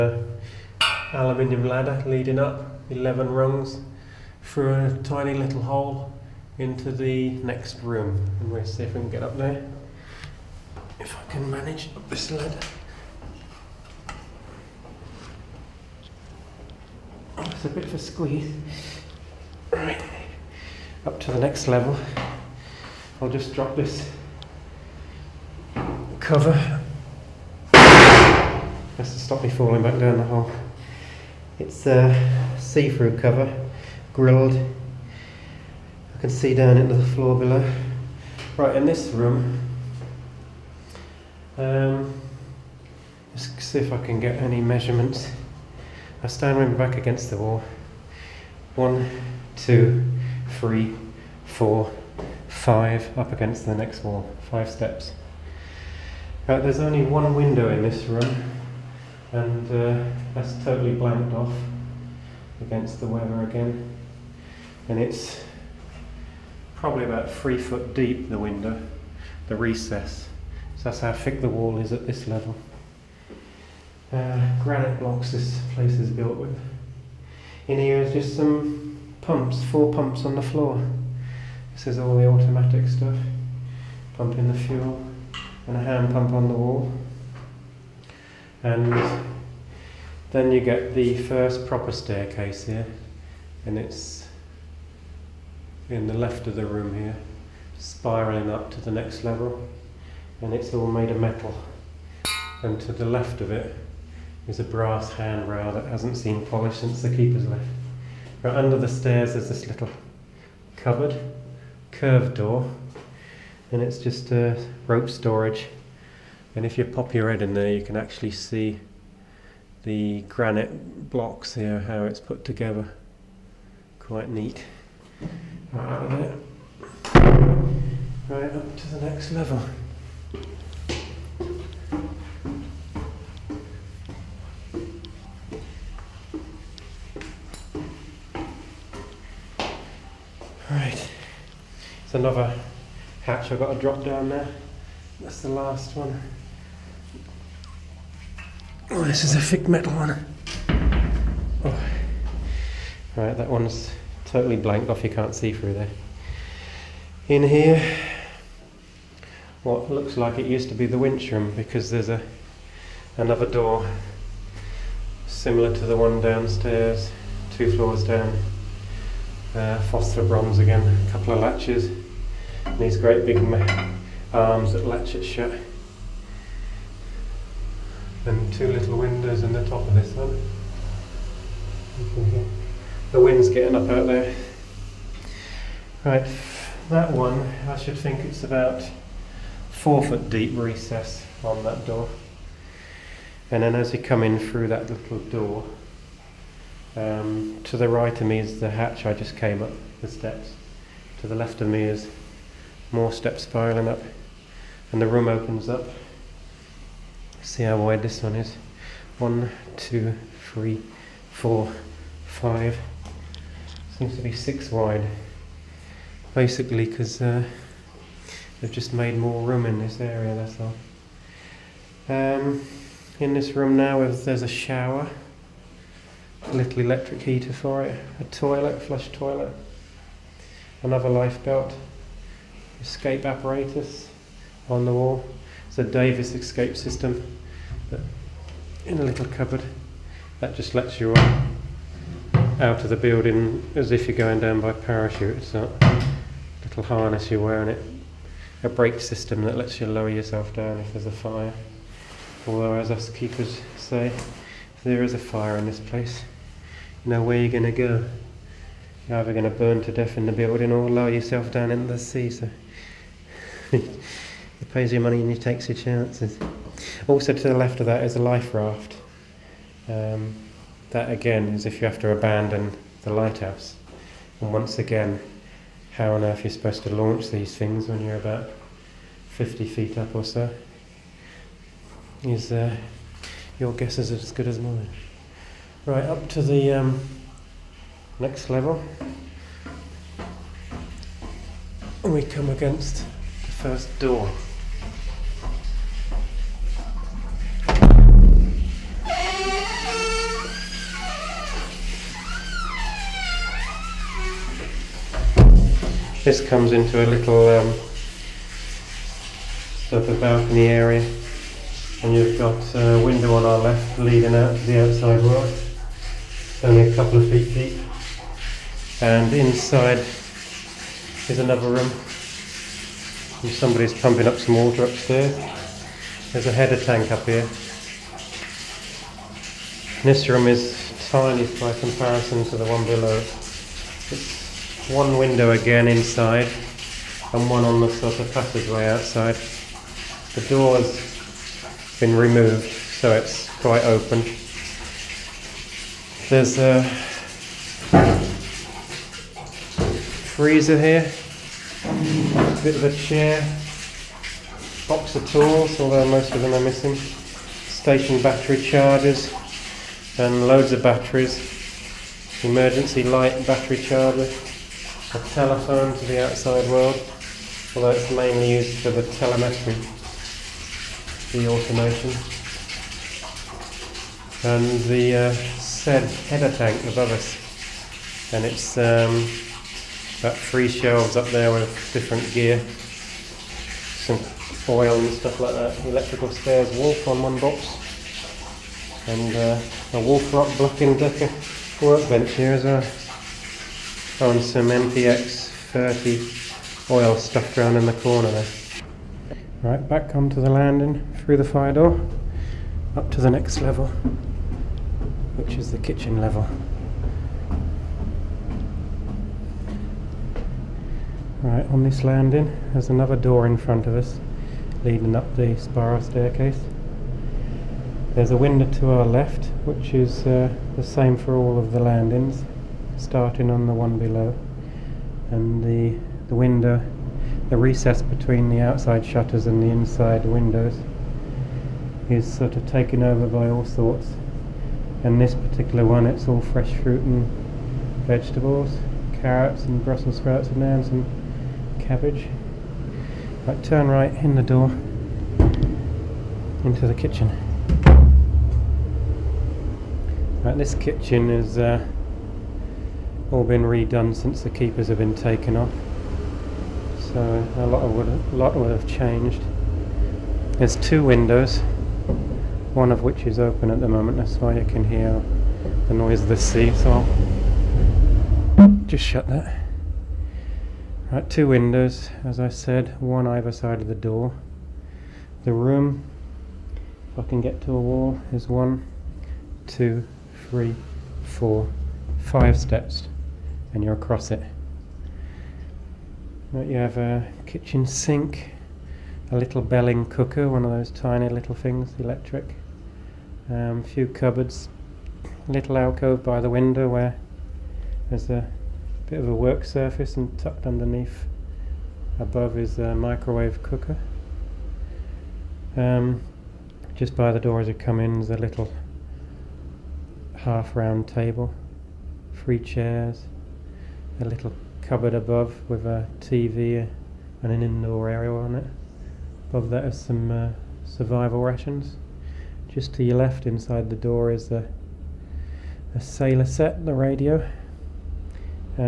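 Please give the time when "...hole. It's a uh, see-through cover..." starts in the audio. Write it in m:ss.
0:30.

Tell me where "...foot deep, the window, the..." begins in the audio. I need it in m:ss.
1:07.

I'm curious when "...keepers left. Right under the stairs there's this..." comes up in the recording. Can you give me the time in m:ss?
1:47.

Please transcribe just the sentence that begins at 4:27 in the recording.
Also, to the left of that is a life raft.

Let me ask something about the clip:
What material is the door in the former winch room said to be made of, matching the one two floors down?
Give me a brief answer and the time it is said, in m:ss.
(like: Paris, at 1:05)
Phosphor bronze, at 2:49.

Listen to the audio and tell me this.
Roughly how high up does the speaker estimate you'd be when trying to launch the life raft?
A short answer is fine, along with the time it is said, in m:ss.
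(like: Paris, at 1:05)
50 feet, at 4:39.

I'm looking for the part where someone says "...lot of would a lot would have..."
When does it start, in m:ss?
7:37.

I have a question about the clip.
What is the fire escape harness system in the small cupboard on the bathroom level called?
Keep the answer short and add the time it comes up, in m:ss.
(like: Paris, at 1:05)
Davis, at 3:55.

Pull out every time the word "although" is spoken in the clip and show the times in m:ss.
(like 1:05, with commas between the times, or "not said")
4:12, 5:55, 6:07.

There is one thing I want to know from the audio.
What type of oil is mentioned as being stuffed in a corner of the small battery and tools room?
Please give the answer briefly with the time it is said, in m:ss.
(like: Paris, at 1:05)
MPX 30, at 6:34.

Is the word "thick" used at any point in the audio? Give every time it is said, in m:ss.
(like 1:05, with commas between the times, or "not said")
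1:11, 2:29.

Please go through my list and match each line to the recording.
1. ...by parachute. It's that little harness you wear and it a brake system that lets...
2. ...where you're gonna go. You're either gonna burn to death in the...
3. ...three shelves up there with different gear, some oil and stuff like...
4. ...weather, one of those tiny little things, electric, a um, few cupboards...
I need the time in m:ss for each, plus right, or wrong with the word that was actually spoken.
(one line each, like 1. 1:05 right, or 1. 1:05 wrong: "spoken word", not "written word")
1. 4:04 right
2. 4:17 right
3. 6:20 right
4. 8:10 wrong: "cooker", not "weather".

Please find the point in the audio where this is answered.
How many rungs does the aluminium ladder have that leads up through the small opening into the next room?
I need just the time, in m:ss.
0:02.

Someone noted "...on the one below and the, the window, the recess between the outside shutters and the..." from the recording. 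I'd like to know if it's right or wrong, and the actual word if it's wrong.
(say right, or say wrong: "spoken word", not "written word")
right.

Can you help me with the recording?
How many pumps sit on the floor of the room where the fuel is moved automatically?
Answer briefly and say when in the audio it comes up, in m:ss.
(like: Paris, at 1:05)
4, at 1:19.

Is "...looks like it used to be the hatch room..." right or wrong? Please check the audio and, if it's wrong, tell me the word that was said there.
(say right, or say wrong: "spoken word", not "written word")
wrong: "winch", not "hatch".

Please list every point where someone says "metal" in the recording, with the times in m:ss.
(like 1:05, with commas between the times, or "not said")
1:41, 2:29.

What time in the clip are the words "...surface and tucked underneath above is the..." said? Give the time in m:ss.
8:19.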